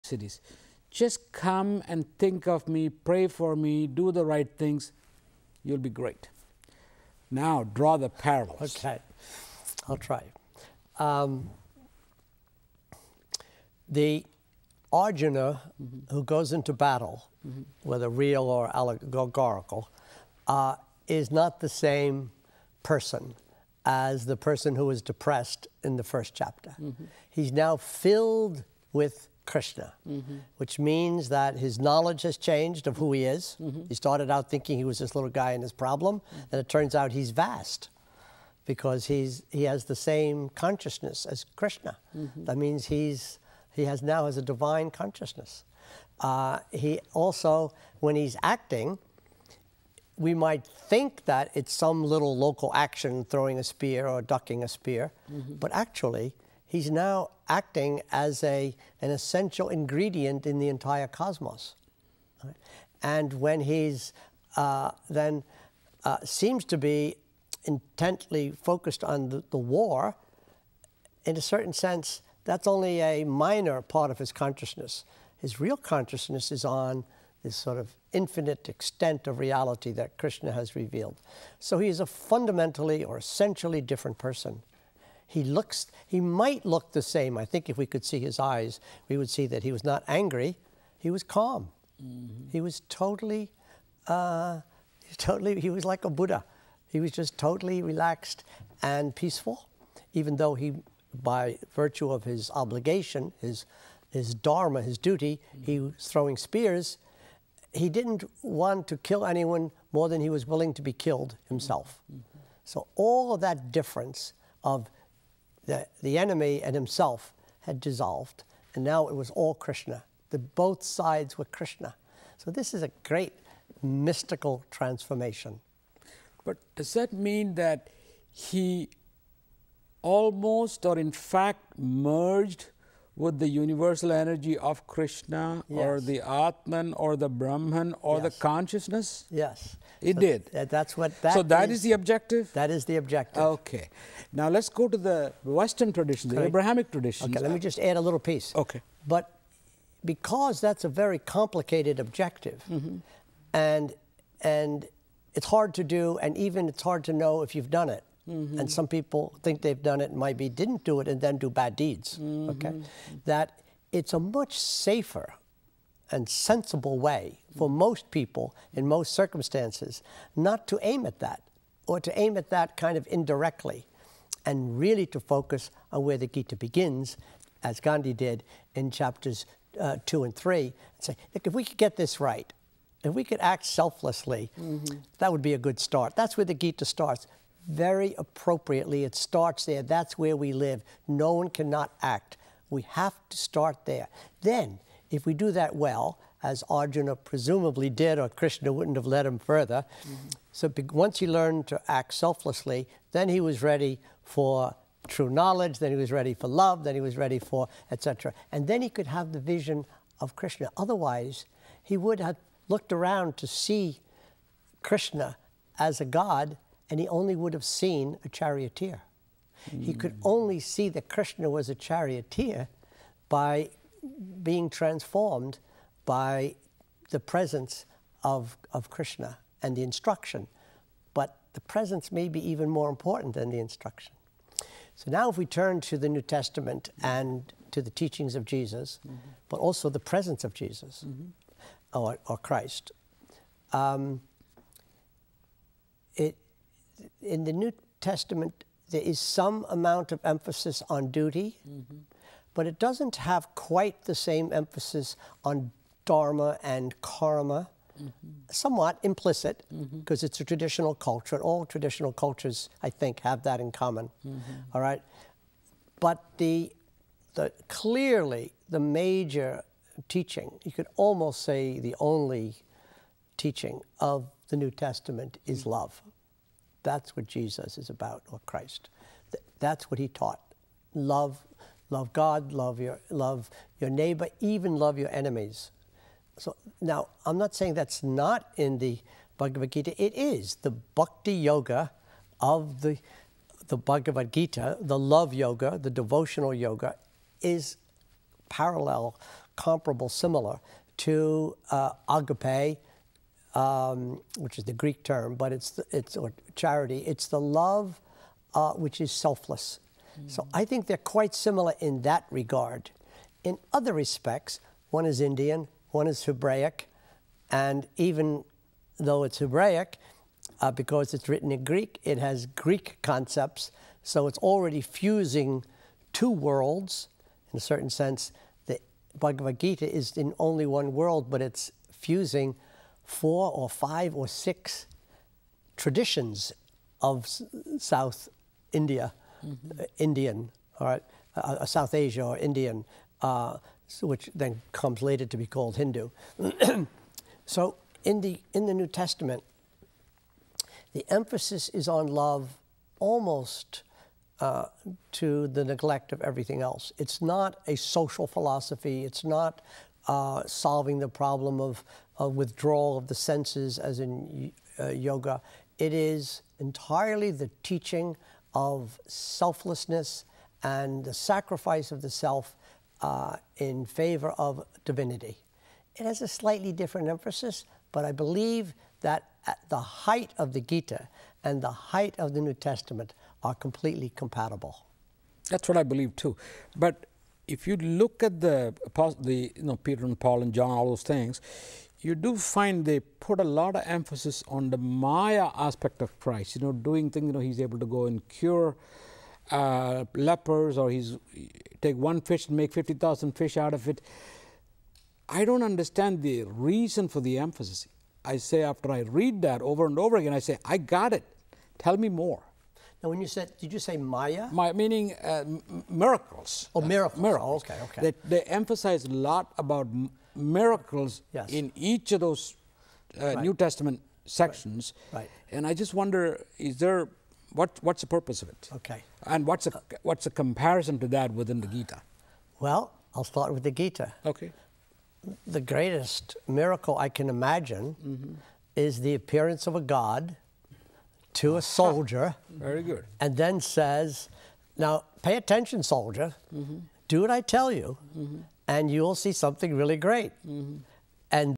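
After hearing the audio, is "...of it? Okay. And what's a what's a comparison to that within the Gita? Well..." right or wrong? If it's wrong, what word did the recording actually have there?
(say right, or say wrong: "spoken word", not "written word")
right.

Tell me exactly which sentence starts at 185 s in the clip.
that would be a good start.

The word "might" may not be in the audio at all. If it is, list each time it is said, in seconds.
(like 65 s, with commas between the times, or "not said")
50 s, 86 s.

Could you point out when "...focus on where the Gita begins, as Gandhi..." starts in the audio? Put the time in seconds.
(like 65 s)
175 s.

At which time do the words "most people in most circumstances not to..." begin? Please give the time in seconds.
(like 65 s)
167 s.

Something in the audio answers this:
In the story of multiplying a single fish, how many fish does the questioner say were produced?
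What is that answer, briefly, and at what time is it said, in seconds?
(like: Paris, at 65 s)
50,000, at 402 s.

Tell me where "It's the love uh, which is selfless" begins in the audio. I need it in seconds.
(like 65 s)
306 s.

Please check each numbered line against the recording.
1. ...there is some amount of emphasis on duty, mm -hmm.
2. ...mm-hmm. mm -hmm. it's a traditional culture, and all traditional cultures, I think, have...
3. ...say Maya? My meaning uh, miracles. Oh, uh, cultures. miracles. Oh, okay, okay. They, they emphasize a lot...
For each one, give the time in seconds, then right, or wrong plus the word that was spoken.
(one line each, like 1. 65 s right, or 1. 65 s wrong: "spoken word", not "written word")
1. 248 s right
2. 259 s right
3. 413 s wrong: "miracles", not "cultures".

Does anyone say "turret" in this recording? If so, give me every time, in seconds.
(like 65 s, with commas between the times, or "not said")
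not said.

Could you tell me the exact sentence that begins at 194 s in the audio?
Then, if we do that well, as Arjuna presumably did, or Krishna wouldn't have led him further.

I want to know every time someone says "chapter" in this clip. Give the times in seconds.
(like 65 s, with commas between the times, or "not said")
26 s, 178 s.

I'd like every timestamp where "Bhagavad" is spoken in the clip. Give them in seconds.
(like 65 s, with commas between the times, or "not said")
289 s, 293 s, 329 s.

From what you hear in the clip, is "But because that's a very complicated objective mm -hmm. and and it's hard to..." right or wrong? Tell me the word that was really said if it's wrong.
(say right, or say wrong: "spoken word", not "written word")
right.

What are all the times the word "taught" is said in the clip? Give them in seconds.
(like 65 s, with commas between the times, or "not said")
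280 s.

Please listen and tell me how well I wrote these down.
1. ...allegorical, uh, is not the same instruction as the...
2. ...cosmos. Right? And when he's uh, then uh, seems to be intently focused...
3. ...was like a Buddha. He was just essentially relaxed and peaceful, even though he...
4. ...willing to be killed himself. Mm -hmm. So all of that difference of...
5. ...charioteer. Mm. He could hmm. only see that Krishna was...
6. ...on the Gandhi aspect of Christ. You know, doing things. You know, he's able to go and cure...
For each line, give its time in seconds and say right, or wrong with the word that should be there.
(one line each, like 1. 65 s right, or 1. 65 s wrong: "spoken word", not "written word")
1. 18 s wrong: "person", not "instruction"
2. 61 s right
3. 95 s wrong: "totally", not "essentially"
4. 110 s right
5. 218 s right
6. 394 s wrong: "Maya", not "Gandhi".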